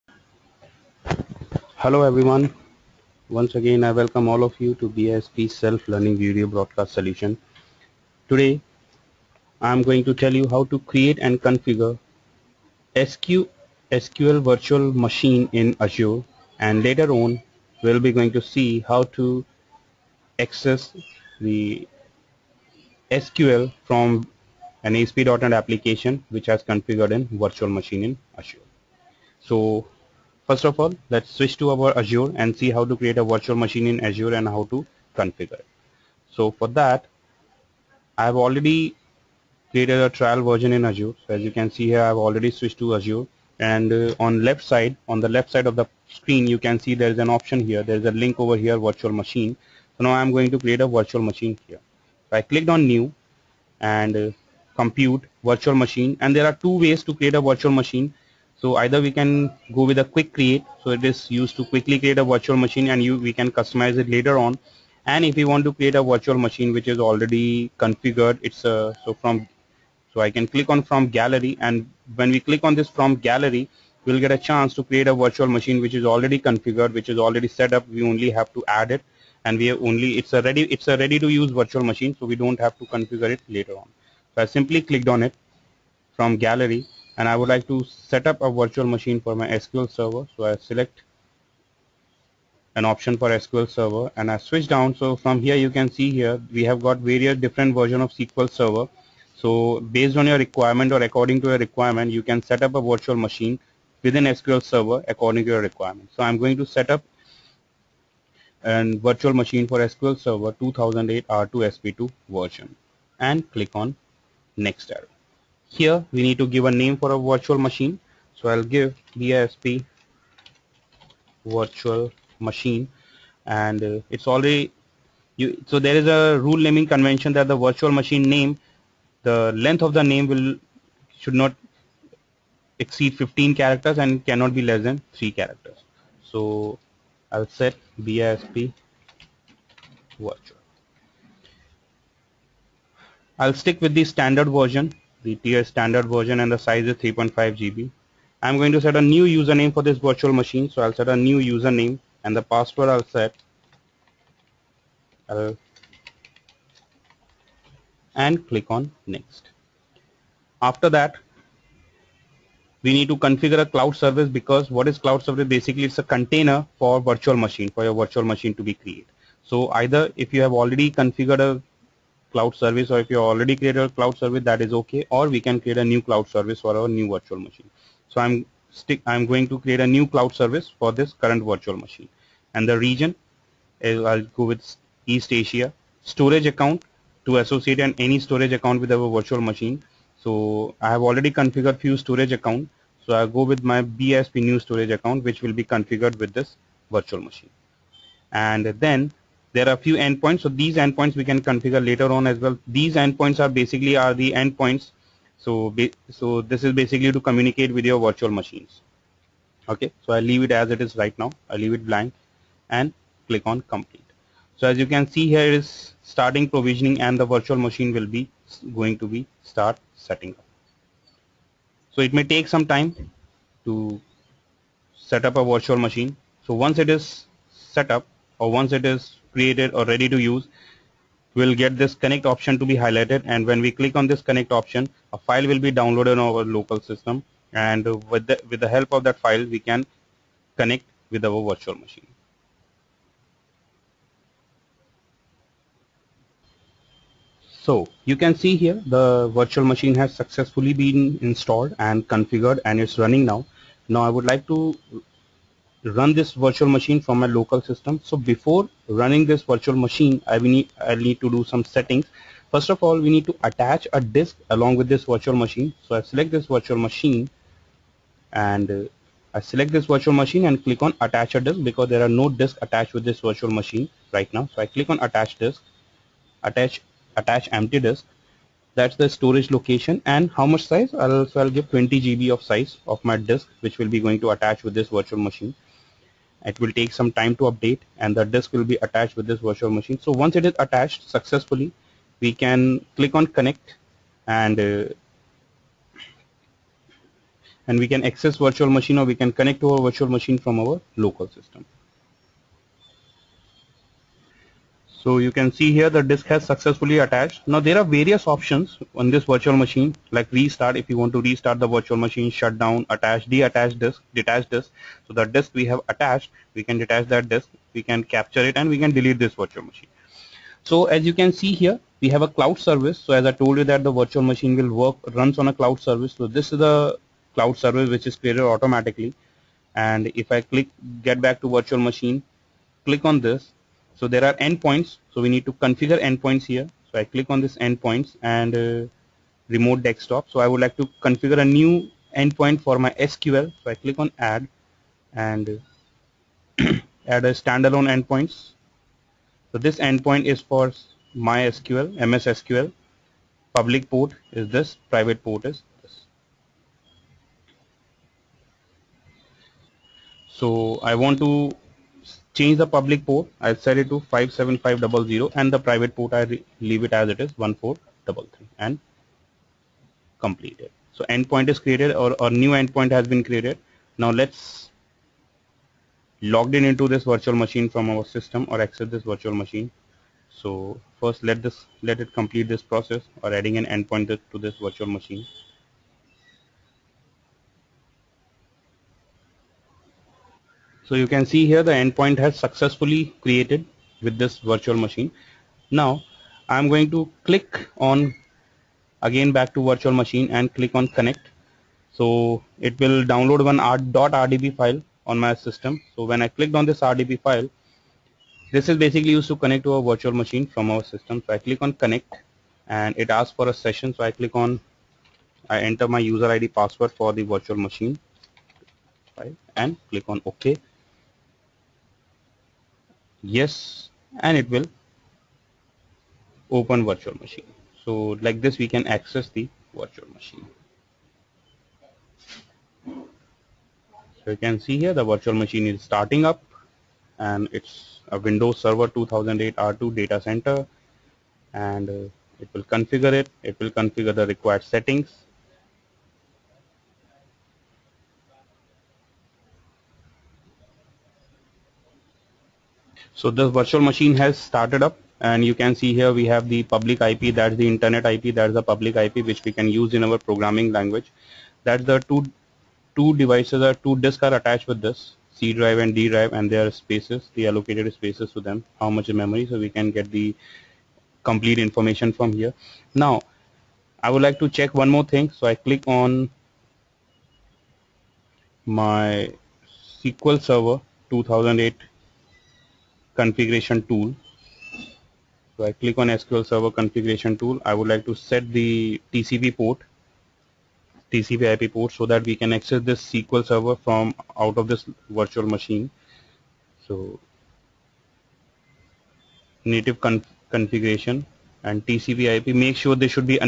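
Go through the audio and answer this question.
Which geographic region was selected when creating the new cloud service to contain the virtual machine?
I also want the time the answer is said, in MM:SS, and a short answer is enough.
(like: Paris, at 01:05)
East Asia, at 03:05.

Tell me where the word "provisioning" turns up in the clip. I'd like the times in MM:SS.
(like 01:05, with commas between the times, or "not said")
03:36.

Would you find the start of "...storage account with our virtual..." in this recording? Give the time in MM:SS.
03:08.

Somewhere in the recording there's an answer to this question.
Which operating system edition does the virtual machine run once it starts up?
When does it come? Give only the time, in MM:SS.
07:18.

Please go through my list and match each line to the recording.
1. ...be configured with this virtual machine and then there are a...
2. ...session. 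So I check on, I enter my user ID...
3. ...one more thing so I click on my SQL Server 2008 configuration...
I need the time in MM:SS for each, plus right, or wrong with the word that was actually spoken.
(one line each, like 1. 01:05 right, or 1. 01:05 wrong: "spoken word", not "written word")
1. 03:15 right
2. 06:53 wrong: "click", not "check"
3. 07:54 right.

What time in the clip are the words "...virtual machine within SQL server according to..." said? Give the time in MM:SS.
01:42.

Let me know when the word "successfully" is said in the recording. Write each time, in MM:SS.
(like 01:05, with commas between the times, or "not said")
04:10, 04:51, 05:06, 06:32.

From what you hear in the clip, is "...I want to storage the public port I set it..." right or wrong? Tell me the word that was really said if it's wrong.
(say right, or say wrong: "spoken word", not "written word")
wrong: "change", not "storage".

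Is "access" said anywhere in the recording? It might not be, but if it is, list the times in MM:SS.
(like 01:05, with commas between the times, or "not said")
00:20, 04:58, 06:18, 07:08, 08:12.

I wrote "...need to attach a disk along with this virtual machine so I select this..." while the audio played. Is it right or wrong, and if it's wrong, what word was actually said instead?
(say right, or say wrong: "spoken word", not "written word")
right.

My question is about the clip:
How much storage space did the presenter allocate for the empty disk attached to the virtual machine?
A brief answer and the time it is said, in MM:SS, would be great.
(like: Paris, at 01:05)
20 GB, at 04:41.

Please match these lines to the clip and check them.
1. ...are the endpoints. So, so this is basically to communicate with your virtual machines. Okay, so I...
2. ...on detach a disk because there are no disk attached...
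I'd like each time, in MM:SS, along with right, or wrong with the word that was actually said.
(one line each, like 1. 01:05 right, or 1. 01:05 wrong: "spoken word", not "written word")
1. 03:23 right
2. 04:30 wrong: "attach", not "detach".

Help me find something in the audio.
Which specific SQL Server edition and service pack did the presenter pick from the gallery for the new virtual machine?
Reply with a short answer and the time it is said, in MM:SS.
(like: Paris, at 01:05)
SQL Server 2008 R2 SP2, at 01:49.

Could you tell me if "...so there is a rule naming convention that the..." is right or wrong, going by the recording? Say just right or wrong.
right.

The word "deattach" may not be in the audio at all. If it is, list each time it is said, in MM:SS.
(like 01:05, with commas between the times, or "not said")
05:13.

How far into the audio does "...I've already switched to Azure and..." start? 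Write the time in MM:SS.
00:42.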